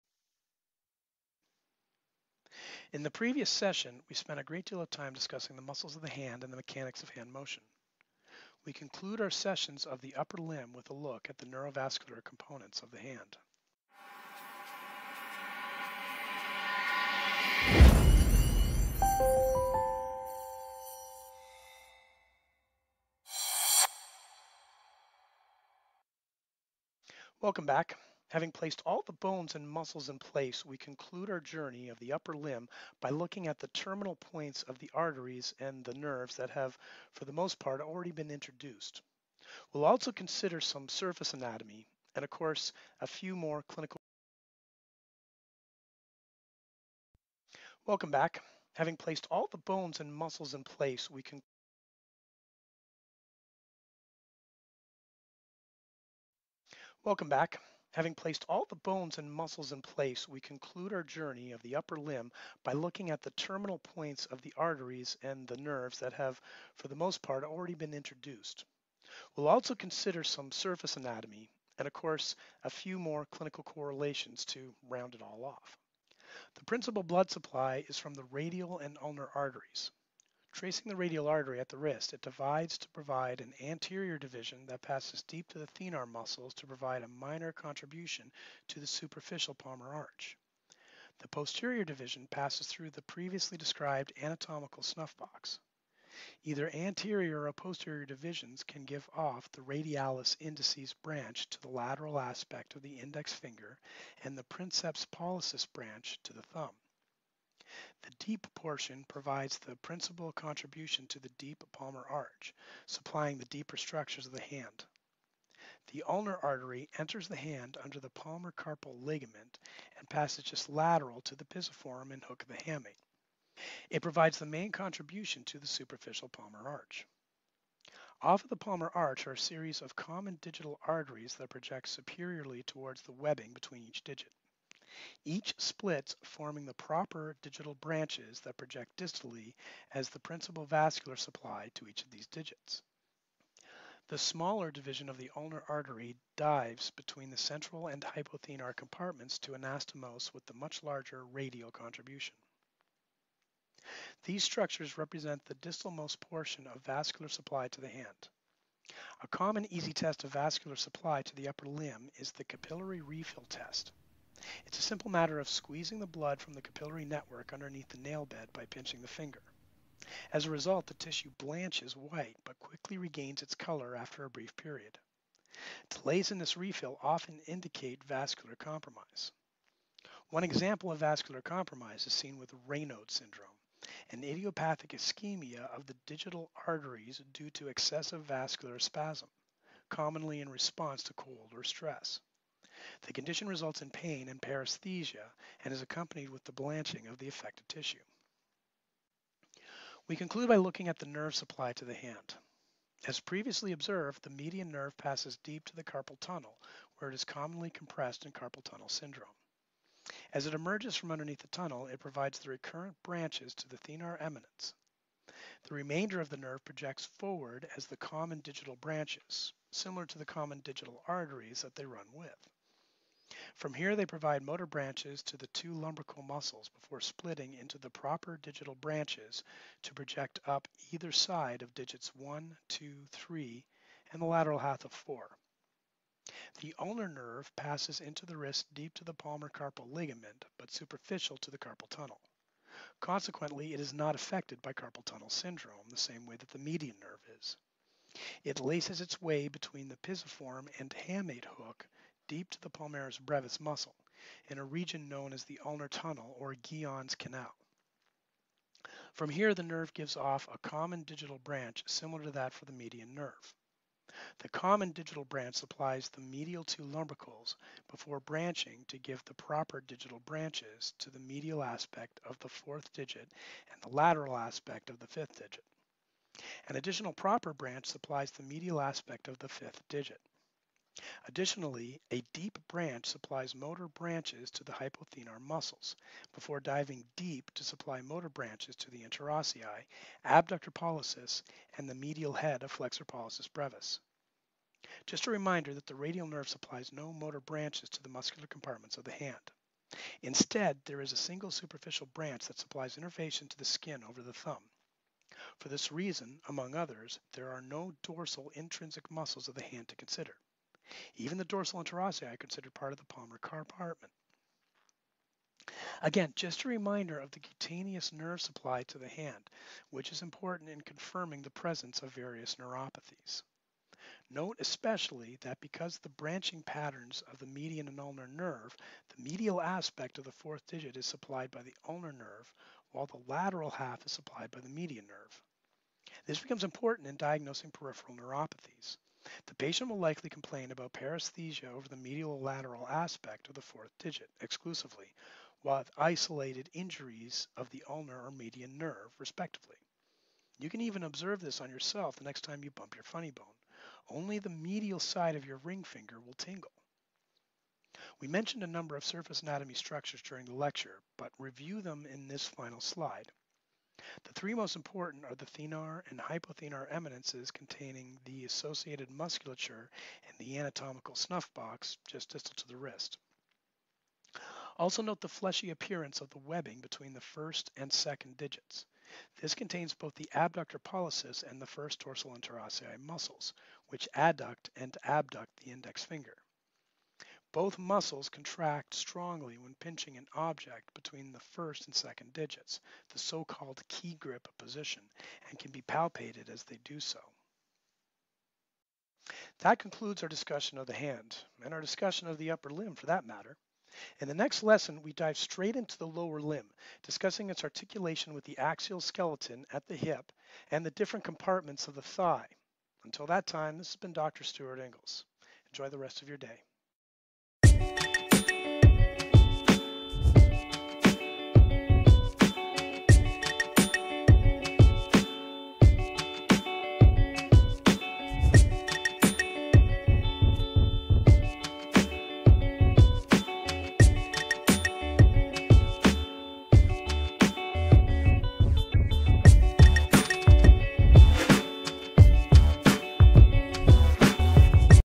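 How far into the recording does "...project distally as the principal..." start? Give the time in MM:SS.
02:18.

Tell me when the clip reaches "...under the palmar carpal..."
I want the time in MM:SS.
01:57.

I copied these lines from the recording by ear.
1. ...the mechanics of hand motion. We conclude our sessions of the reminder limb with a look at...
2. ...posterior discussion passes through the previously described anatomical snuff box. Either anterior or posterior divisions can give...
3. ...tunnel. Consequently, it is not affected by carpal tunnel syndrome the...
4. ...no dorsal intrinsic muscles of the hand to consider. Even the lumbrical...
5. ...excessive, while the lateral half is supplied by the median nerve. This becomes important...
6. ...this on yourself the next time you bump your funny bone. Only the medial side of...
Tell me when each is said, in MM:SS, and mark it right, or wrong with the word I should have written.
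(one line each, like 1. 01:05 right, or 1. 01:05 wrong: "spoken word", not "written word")
1. 00:06 wrong: "upper", not "reminder"
2. 01:31 wrong: "division", not "discussion"
3. 04:01 right
4. 05:07 wrong: "dorsal", not "lumbrical"
5. 05:32 wrong: "nerve", not "excessive"
6. 05:51 right.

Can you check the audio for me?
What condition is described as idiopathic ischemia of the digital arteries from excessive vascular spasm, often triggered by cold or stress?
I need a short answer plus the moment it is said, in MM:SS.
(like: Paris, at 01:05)
Raynaud's syndrome, at 03:02.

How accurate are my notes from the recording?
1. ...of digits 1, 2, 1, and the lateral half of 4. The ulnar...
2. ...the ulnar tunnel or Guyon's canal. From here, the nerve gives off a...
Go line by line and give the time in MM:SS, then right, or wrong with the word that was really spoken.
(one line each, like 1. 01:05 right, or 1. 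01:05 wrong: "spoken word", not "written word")
1. 03:51 wrong: "3", not "1"
2. 04:15 right.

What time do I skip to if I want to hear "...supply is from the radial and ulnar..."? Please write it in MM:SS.
01:17.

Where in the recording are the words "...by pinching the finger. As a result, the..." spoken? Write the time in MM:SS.
02:48.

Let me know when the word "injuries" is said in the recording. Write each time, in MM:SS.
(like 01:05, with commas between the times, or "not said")
05:46.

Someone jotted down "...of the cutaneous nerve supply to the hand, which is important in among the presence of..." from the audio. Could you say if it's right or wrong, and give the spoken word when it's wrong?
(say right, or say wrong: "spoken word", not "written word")
wrong: "confirming", not "among".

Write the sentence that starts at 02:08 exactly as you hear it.
Off of the palmar arch are a series of common digital arteries that project superiorly towards the webbing between each digit.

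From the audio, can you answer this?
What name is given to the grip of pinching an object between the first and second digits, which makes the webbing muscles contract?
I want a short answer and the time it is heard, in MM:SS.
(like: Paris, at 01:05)
key grip, at 06:33.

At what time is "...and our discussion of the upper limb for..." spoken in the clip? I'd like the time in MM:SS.
06:41.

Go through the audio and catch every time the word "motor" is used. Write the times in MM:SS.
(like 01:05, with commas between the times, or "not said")
03:44, 04:43, 04:48, 04:57.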